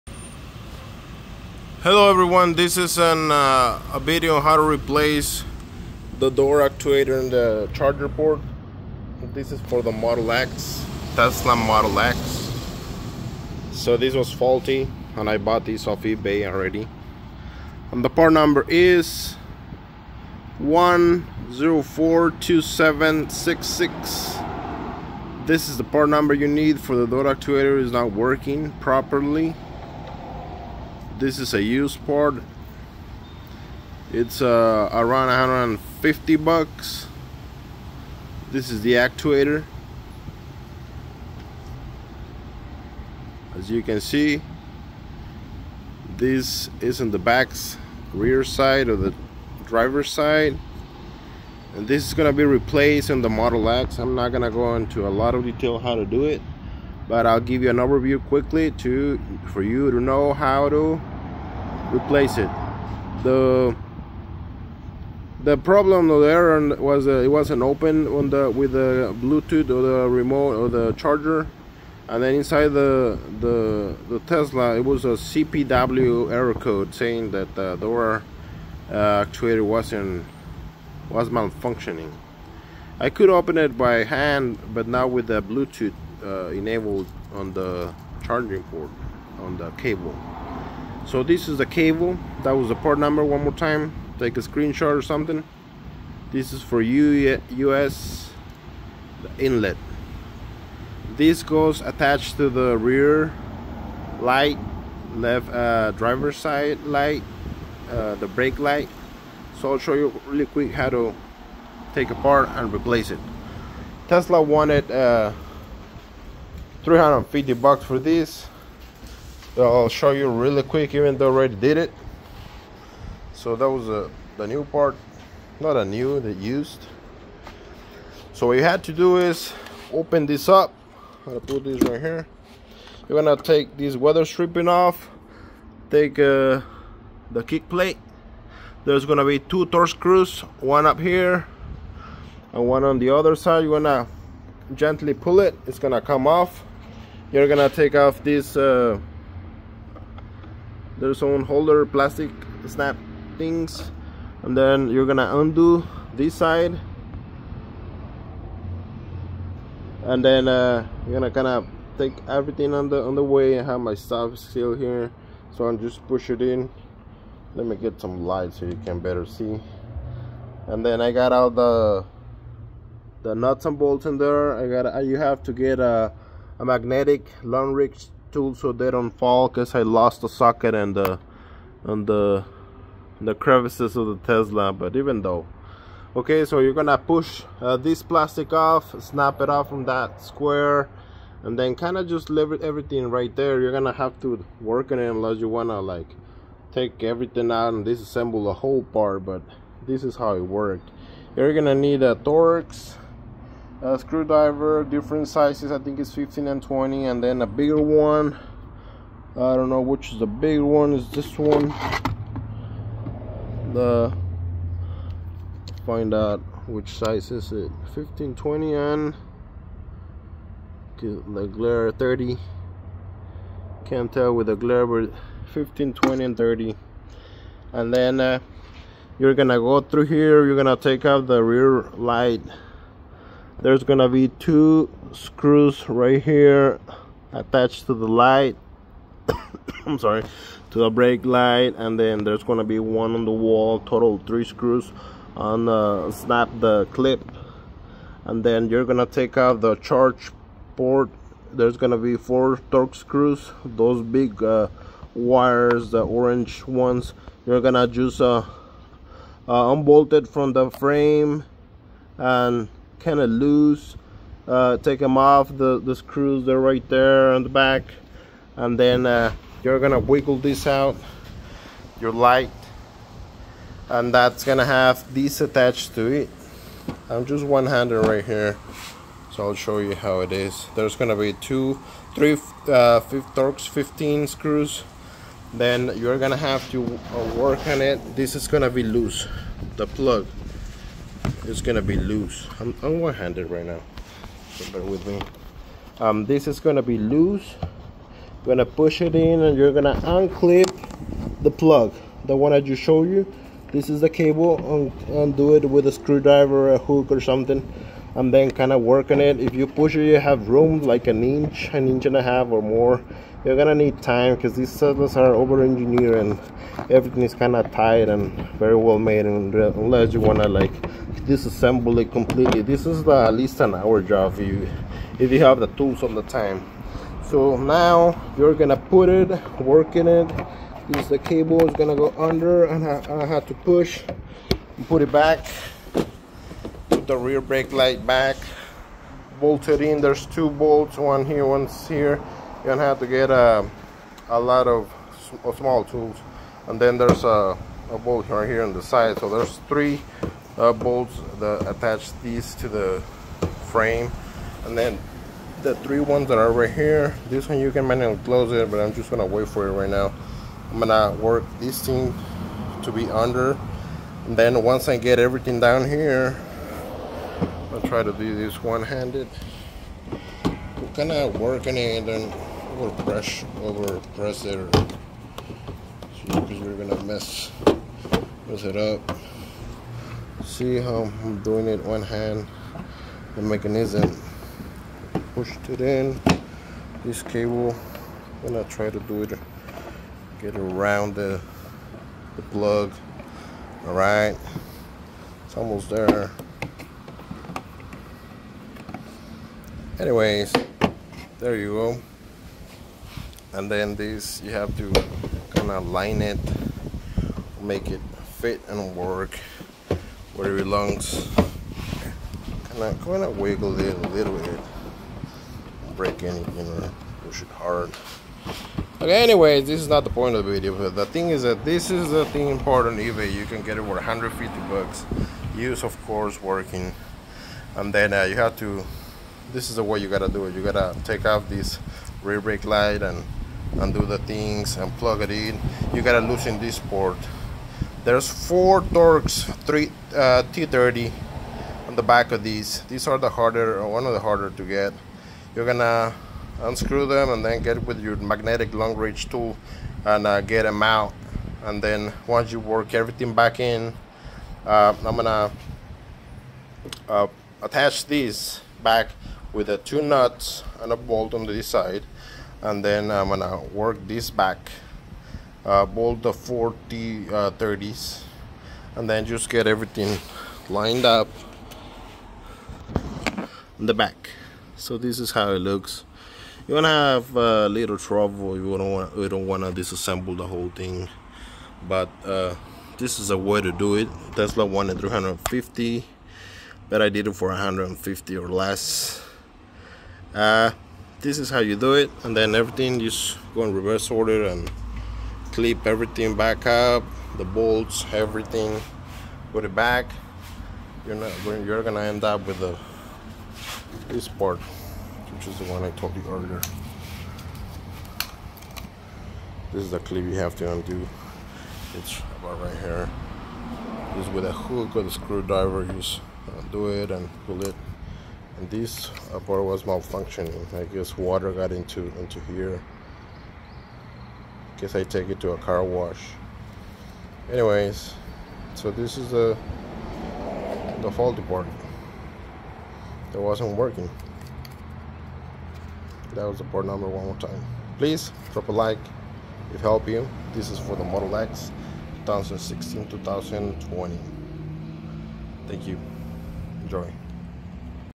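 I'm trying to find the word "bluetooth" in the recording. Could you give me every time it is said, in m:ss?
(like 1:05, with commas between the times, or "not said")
1:09, 1:25.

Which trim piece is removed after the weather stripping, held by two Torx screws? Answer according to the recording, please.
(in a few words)
kick plate.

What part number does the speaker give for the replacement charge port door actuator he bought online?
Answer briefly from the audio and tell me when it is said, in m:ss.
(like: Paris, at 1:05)
1042766, at 0:20.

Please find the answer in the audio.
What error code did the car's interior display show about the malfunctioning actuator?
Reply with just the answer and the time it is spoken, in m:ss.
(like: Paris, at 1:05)
cpw error code, at 1:15.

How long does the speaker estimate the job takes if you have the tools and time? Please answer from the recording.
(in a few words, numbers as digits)
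an hour.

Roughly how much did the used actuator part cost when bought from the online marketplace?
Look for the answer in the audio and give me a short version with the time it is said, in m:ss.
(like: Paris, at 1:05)
150 bucks, at 0:34.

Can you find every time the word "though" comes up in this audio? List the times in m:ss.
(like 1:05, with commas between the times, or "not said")
2:01, 3:05.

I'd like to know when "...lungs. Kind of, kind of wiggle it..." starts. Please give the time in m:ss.
6:50.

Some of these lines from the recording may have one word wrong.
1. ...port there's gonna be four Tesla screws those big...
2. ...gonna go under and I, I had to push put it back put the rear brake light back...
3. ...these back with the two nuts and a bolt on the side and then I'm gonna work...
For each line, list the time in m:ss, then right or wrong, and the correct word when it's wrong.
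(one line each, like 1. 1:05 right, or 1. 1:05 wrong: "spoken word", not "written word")
1. 4:10 wrong: "Torx", not "Tesla"
2. 5:31 right
3. 7:38 right.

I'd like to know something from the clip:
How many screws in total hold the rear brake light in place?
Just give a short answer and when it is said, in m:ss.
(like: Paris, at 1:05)
3, at 4:03.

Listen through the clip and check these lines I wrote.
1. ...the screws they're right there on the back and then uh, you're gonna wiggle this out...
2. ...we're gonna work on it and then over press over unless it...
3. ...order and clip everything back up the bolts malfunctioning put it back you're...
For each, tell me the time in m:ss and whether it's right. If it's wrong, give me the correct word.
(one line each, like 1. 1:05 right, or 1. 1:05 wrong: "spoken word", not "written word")
1. 4:25 right
2. 6:10 wrong: "press", not "unless"
3. 8:14 wrong: "everything", not "malfunctioning".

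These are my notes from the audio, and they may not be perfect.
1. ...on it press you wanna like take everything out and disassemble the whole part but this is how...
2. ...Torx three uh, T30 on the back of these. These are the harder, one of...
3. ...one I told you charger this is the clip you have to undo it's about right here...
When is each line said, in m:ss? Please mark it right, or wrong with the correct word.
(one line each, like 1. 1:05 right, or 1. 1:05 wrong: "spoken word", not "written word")
1. 3:14 wrong: "unless", not "press"
2. 7:18 right
3. 8:25 wrong: "earlier", not "charger".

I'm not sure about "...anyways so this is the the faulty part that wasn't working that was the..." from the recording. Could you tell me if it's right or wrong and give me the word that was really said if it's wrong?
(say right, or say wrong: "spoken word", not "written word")
right.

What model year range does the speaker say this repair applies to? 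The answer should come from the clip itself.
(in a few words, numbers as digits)
2016-2020.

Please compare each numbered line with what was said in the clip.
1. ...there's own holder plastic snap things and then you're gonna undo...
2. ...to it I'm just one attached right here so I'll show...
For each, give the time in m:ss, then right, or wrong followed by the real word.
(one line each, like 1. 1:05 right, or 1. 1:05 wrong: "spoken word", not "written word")
1. 2:31 right
2. 4:35 wrong: "handed", not "attached".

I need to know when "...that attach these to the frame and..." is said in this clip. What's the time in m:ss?
5:51.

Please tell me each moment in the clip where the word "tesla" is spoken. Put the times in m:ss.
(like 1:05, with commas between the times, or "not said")
0:11, 1:14, 1:54, 3:04, 8:04.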